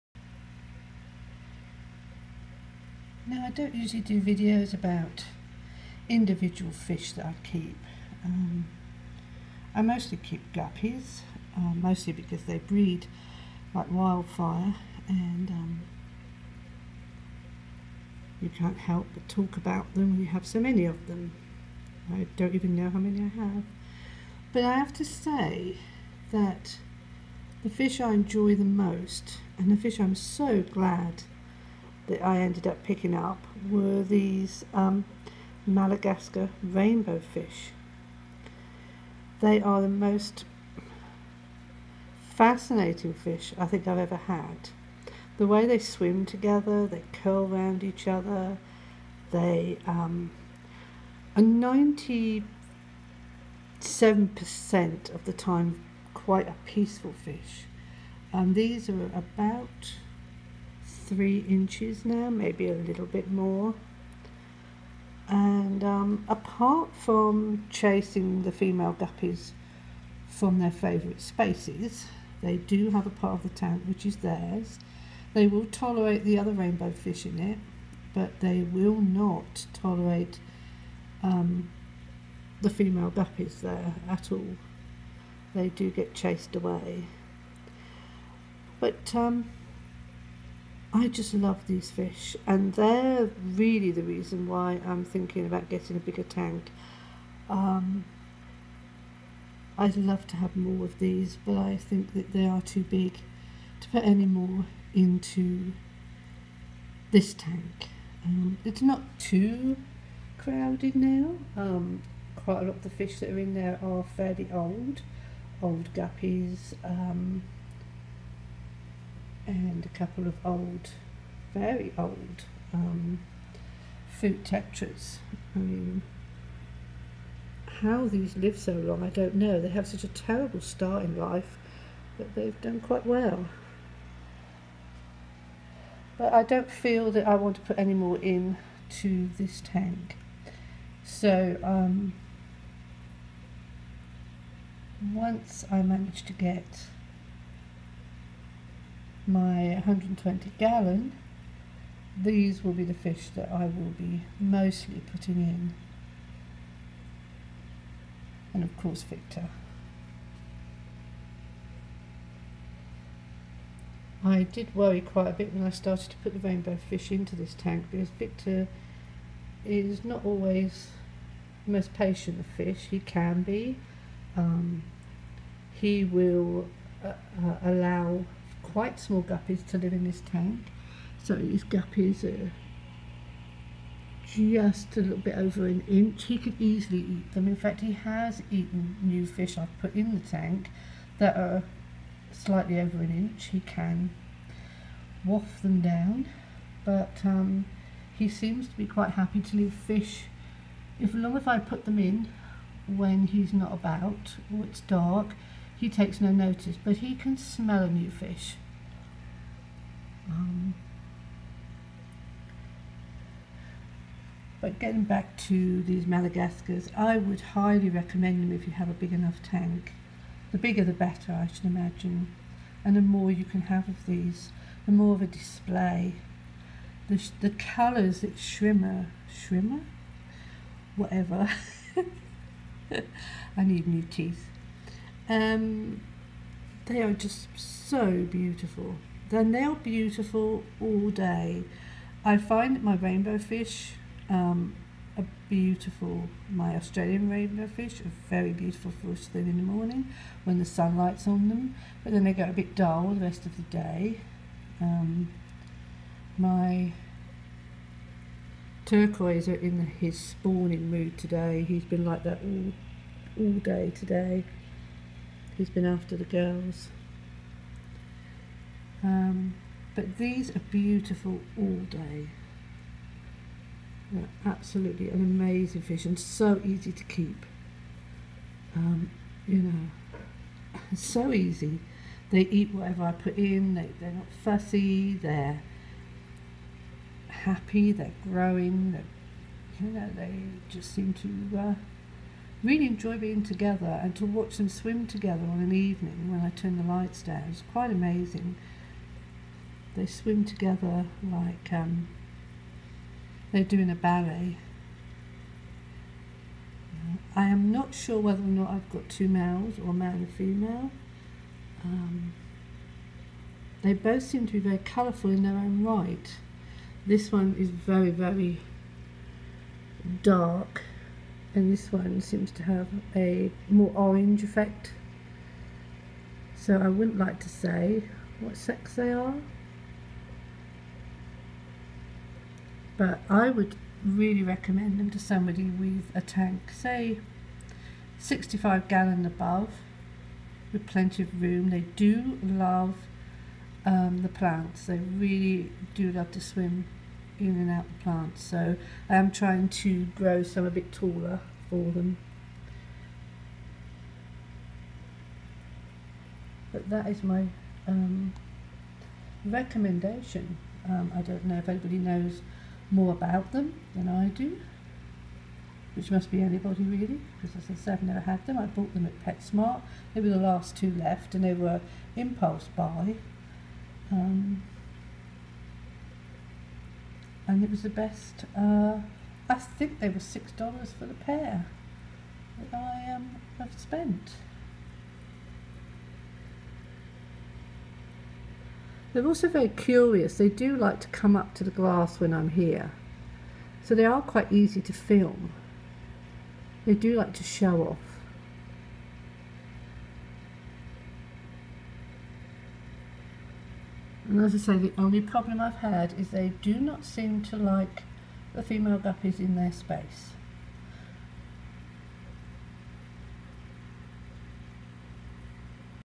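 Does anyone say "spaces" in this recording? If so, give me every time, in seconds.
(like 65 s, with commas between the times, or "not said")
71 s, 409 s.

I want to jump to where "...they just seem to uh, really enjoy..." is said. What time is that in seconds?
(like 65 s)
290 s.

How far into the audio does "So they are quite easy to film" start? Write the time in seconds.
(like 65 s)
393 s.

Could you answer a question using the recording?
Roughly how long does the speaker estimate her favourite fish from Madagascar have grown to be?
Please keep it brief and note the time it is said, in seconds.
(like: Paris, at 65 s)
3 inches, at 61 s.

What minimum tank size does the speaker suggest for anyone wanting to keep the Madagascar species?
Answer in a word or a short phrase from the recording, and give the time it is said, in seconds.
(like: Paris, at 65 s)
65 gallons, at 338 s.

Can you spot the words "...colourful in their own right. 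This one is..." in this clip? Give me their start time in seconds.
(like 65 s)
314 s.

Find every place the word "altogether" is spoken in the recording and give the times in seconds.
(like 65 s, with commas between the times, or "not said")
not said.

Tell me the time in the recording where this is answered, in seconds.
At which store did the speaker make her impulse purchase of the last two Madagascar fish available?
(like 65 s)
369 s.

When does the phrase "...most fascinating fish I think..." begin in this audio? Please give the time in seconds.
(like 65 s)
39 s.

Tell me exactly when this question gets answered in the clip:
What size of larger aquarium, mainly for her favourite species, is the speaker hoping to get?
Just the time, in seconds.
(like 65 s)
149 s.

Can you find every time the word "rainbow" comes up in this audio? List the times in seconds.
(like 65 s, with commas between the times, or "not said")
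36 s, 76 s, 166 s, 242 s, 247 s.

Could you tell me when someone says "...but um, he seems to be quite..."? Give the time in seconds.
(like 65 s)
196 s.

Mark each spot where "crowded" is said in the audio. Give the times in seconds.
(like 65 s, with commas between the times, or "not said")
110 s.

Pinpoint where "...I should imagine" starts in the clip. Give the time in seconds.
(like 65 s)
221 s.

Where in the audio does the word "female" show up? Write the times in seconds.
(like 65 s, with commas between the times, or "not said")
68 s, 82 s, 310 s, 408 s.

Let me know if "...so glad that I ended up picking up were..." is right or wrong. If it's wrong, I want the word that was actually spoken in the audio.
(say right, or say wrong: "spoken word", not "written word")
right.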